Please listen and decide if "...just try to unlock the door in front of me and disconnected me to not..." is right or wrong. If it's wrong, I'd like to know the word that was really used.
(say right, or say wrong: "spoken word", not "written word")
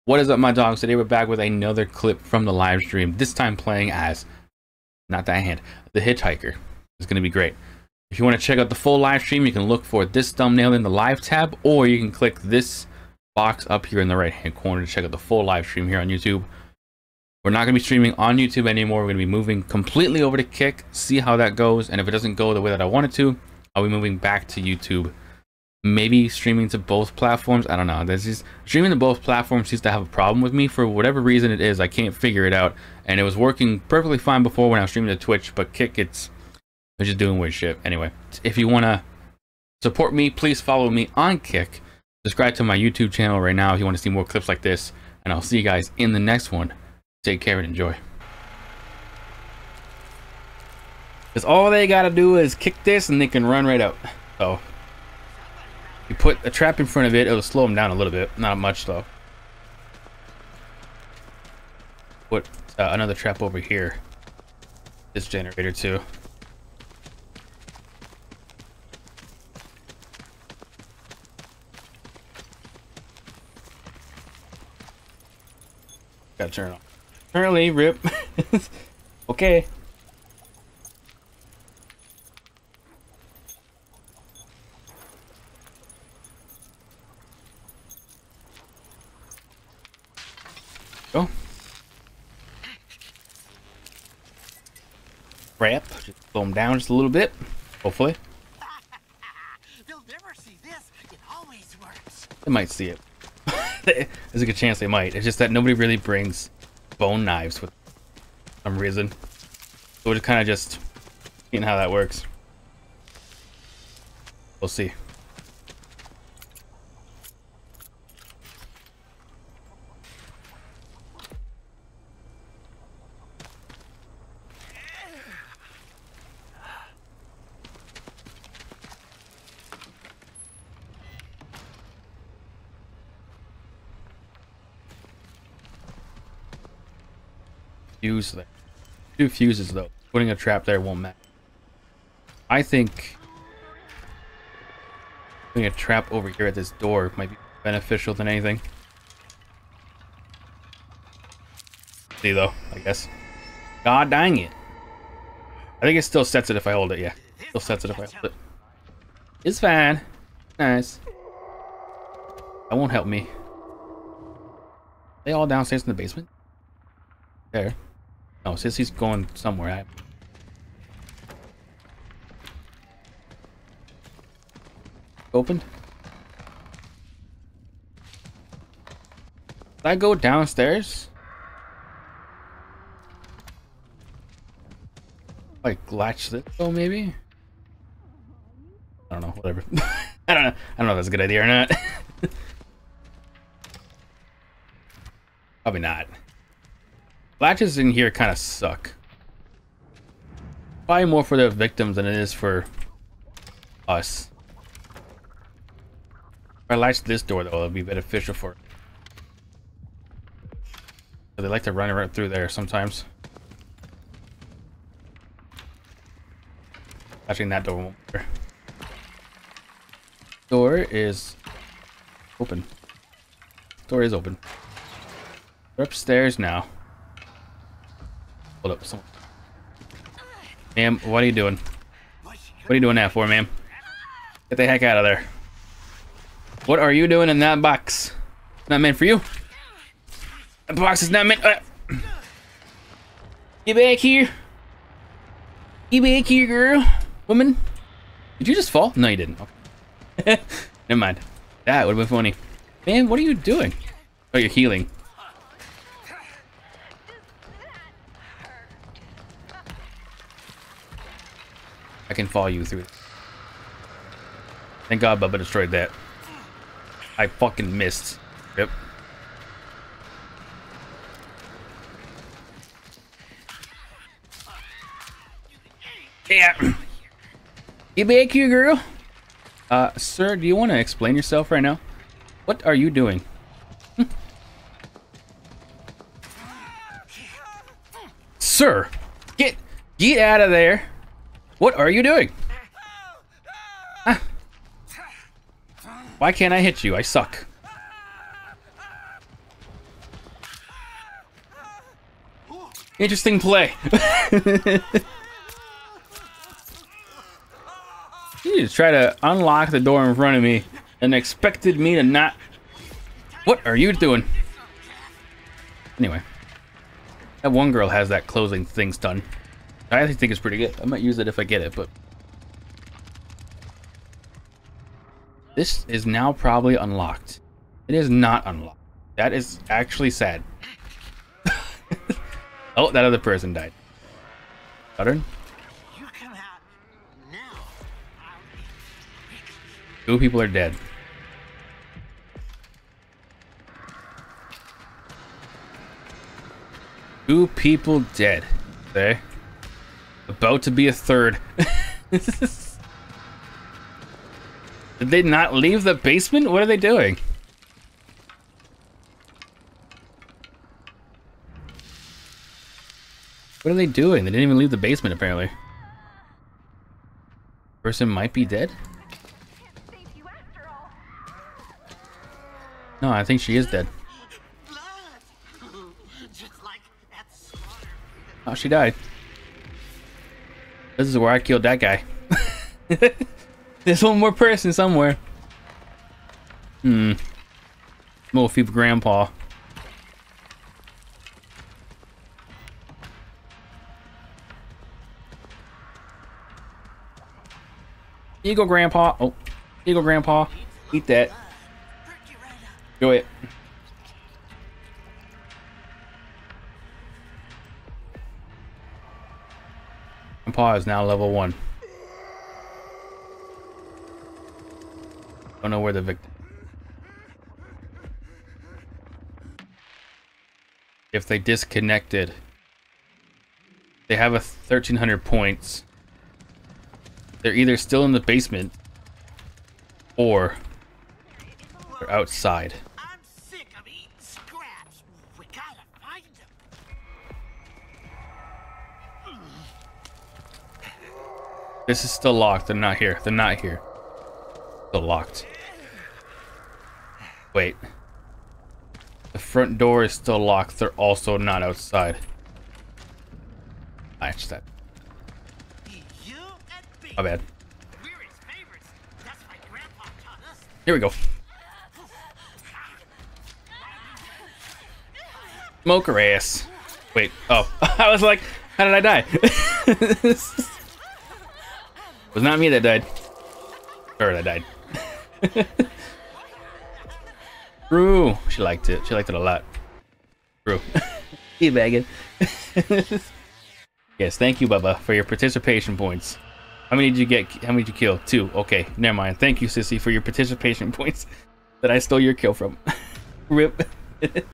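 wrong: "expected", not "disconnected".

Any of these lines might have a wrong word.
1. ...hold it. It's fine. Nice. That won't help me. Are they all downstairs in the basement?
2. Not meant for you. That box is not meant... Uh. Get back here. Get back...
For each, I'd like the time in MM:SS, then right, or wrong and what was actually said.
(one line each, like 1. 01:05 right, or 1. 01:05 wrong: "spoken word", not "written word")
1. 02:38 right
2. 03:58 right.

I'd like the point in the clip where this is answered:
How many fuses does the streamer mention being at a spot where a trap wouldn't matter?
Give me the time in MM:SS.
02:19.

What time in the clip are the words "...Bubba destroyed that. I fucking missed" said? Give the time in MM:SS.
04:25.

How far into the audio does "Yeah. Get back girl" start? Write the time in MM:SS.
04:36.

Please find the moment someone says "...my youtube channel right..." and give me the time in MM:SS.
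00:42.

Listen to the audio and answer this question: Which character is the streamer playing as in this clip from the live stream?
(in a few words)
the Hitchhiker.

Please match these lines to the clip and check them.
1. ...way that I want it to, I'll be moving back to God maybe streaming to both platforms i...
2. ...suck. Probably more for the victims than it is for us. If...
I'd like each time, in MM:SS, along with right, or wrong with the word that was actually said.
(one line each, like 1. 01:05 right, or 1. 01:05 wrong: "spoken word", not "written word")
1. 00:22 wrong: "YouTube", not "God"
2. 03:18 right.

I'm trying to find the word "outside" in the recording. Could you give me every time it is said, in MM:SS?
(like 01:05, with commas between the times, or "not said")
07:12, 07:31.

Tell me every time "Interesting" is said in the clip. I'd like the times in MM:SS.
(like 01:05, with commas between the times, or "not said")
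05:02.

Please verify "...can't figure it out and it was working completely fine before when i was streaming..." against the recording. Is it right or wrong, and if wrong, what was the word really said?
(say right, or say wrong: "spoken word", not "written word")
wrong: "perfectly", not "completely".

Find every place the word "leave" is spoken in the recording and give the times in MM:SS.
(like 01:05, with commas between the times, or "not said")
05:55, 06:04.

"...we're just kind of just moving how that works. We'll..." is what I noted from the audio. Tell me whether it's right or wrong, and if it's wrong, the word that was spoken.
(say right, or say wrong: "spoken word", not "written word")
wrong: "seeing", not "moving".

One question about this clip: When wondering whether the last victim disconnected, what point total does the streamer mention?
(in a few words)
1300.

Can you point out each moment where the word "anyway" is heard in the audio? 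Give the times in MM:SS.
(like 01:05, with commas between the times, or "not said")
00:37, 05:15.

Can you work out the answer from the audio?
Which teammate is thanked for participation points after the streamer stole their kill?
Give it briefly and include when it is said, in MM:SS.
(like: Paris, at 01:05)
Sissy, at 08:09.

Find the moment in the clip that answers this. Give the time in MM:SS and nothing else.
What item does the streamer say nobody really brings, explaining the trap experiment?
01:46.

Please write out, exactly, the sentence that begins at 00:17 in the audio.
We're not going to be streaming on YouTube anymore.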